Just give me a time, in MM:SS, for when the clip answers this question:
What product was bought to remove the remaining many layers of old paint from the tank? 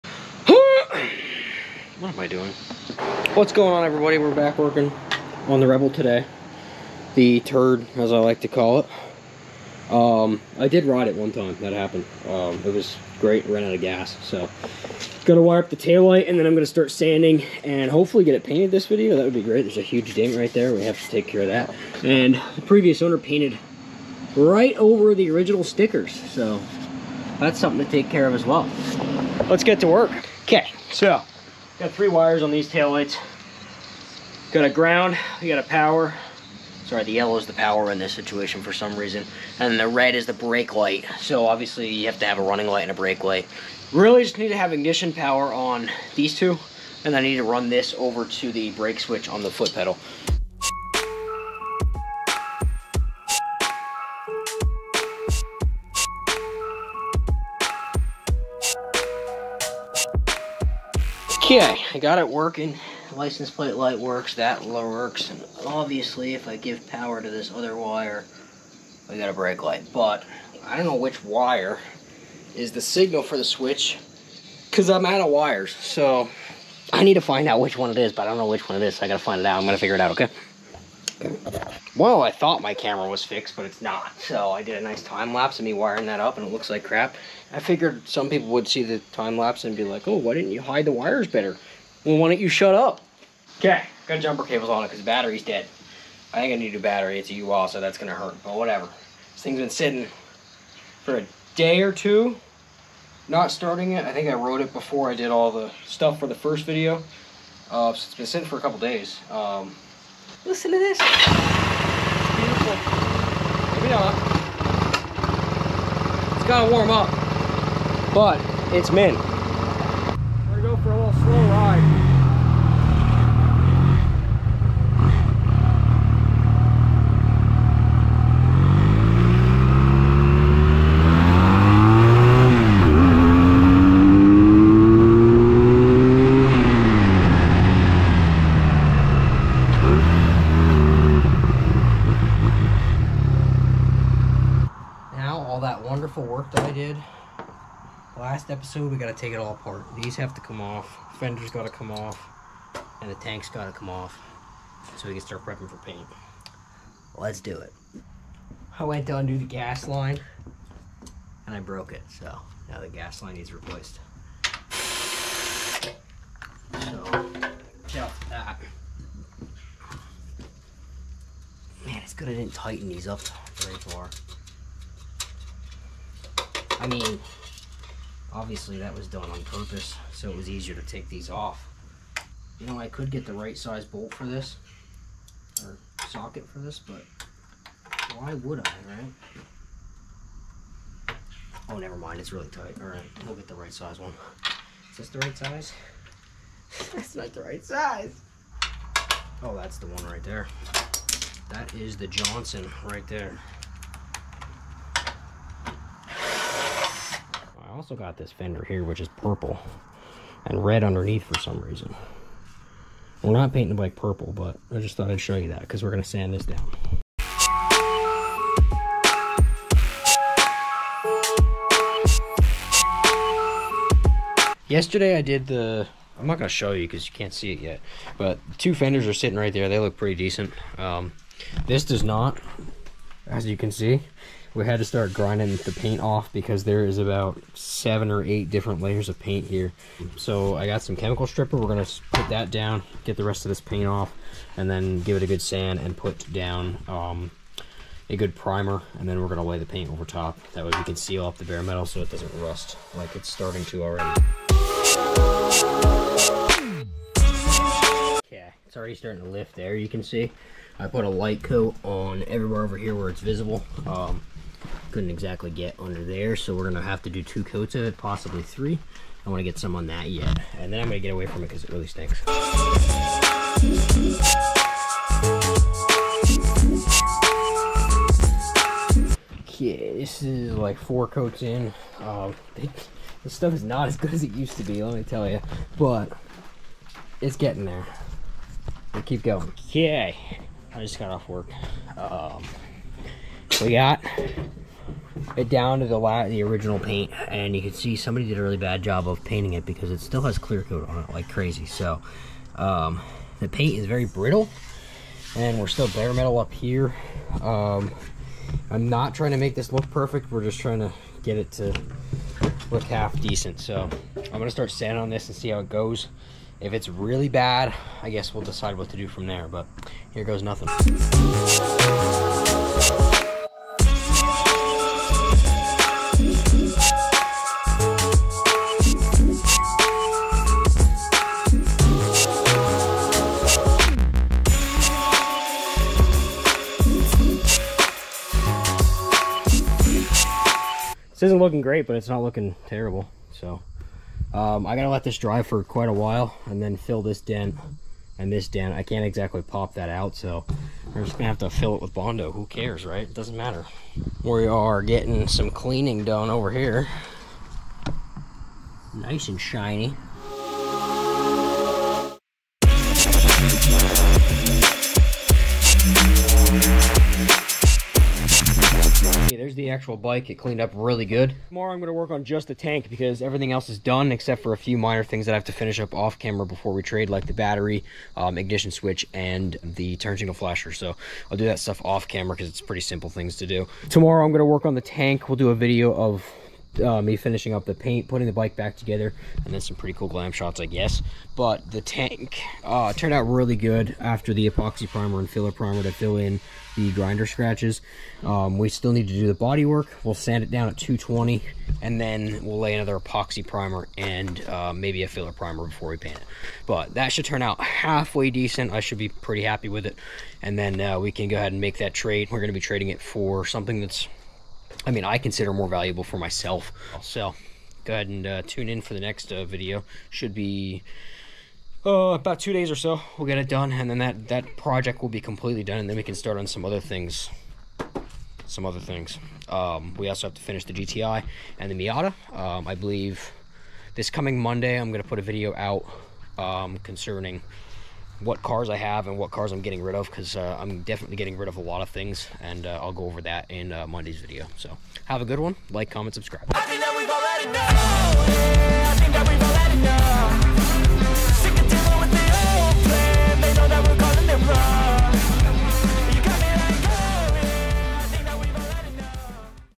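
04:00.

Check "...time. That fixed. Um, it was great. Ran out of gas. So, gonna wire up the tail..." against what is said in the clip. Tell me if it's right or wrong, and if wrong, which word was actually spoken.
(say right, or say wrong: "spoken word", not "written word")
wrong: "happened", not "fixed".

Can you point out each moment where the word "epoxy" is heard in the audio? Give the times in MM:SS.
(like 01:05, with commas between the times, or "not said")
06:34, 06:42.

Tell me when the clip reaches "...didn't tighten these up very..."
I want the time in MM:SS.
02:52.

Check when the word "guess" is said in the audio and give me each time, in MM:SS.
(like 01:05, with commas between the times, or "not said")
05:18, 06:30.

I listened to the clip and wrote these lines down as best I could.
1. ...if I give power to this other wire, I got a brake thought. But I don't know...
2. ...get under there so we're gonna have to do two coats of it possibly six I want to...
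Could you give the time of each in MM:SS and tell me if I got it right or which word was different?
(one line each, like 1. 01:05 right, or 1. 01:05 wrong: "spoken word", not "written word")
1. 01:06 wrong: "light", not "thought"
2. 04:25 wrong: "three", not "six".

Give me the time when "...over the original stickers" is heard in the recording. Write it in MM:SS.
00:24.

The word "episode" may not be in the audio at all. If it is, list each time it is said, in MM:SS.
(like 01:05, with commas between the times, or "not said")
02:28.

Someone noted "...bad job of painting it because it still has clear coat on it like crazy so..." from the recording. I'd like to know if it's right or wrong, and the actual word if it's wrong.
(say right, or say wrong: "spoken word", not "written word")
right.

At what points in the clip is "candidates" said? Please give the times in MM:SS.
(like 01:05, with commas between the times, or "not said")
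not said.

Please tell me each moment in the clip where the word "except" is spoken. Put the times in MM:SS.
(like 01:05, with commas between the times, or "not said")
06:14.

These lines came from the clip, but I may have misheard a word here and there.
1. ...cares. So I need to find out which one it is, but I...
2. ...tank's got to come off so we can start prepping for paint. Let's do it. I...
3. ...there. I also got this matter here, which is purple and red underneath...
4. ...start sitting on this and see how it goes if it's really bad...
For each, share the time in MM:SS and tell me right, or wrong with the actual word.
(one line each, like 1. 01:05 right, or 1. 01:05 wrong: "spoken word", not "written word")
1. 01:15 wrong: "wires", not "cares"
2. 02:33 right
3. 03:23 wrong: "fender", not "matter"
4. 05:14 wrong: "sanding", not "sitting".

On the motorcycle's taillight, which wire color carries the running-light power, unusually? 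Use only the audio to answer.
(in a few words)
Yellow.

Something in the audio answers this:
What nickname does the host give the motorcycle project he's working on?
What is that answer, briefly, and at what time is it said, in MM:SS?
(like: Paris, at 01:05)
The turd, at 00:07.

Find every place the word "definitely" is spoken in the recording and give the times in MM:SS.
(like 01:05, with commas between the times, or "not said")
07:20.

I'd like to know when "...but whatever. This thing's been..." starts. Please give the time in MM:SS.
01:38.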